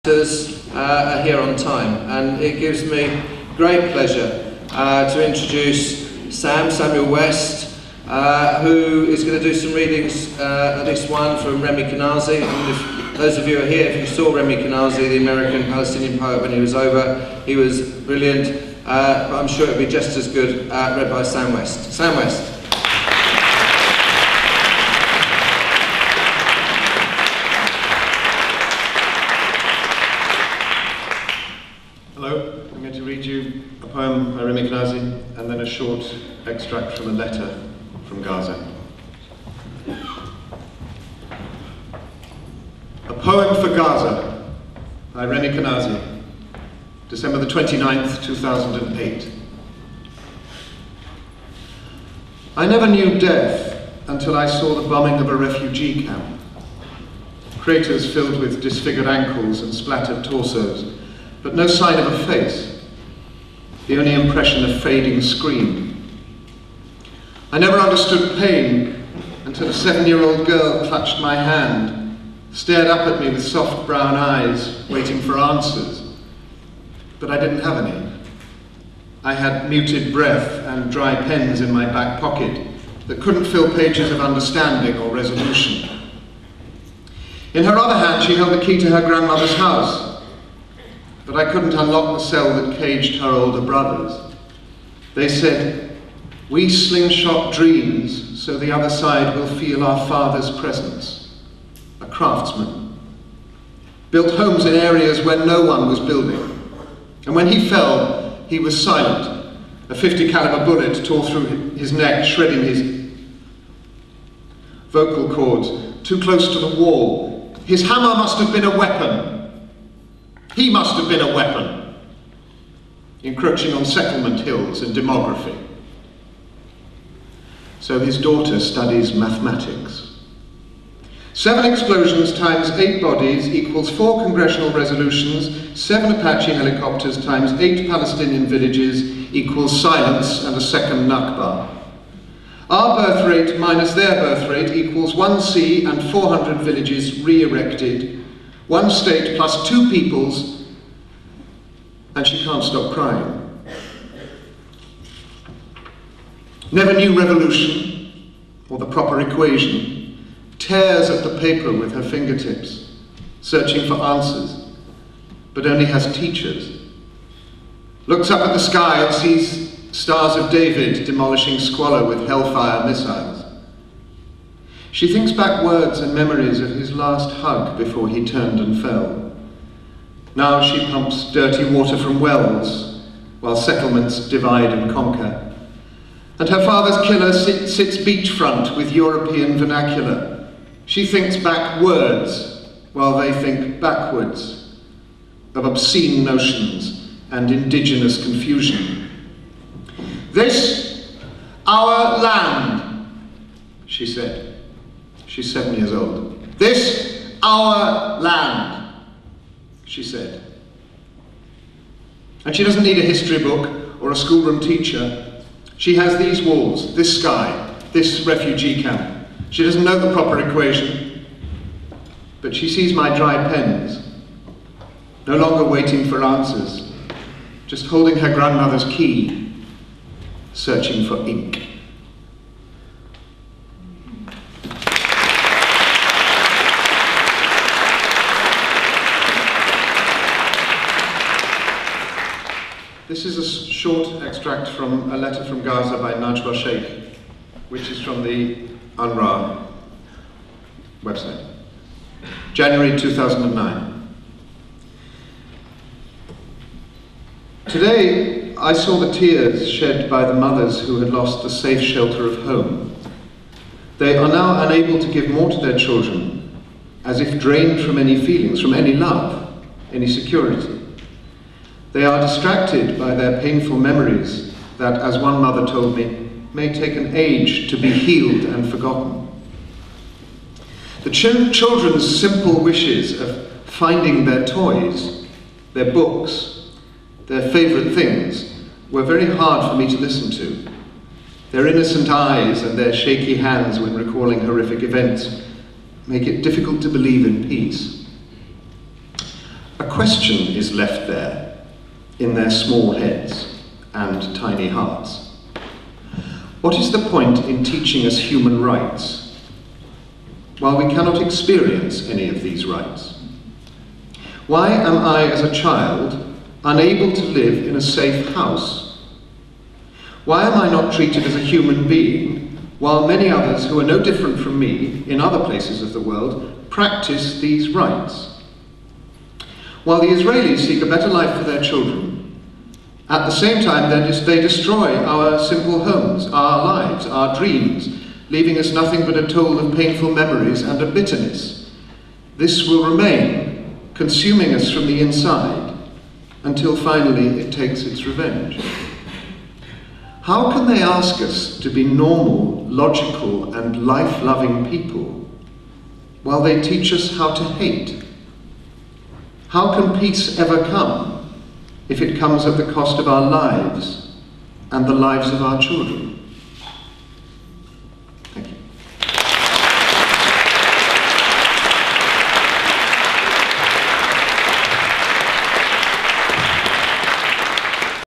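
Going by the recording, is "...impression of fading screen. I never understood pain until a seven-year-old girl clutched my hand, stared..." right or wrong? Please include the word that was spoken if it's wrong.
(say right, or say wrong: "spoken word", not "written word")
right.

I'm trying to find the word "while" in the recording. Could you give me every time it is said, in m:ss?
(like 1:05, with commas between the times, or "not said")
3:03, 3:12, 5:10, 5:22, 5:29, 5:56.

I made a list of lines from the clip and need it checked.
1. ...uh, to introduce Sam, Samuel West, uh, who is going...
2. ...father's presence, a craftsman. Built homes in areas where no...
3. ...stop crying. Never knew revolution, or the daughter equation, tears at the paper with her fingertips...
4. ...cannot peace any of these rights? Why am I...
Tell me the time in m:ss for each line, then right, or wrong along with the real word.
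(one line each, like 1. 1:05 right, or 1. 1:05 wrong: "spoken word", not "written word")
1. 0:04 right
2. 1:40 right
3. 2:32 wrong: "proper", not "daughter"
4. 5:10 wrong: "experience", not "peace".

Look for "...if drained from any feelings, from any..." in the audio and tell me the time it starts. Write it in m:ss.
4:27.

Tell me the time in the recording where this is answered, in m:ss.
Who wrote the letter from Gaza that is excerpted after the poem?
4:06.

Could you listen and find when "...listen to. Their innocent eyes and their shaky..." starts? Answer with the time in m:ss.
4:49.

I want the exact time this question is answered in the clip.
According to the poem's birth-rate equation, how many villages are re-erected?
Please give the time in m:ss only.
2:26.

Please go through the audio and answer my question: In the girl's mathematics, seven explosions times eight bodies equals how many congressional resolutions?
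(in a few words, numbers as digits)
4.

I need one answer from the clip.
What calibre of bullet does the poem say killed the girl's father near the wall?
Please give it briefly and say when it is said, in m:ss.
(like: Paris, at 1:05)
50 caliber, at 1:49.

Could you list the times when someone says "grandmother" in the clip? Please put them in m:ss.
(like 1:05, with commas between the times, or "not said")
1:29, 3:48.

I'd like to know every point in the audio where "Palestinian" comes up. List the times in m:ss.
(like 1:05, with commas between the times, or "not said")
0:15, 2:17.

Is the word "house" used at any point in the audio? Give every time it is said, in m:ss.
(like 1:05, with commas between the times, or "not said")
1:29, 5:18.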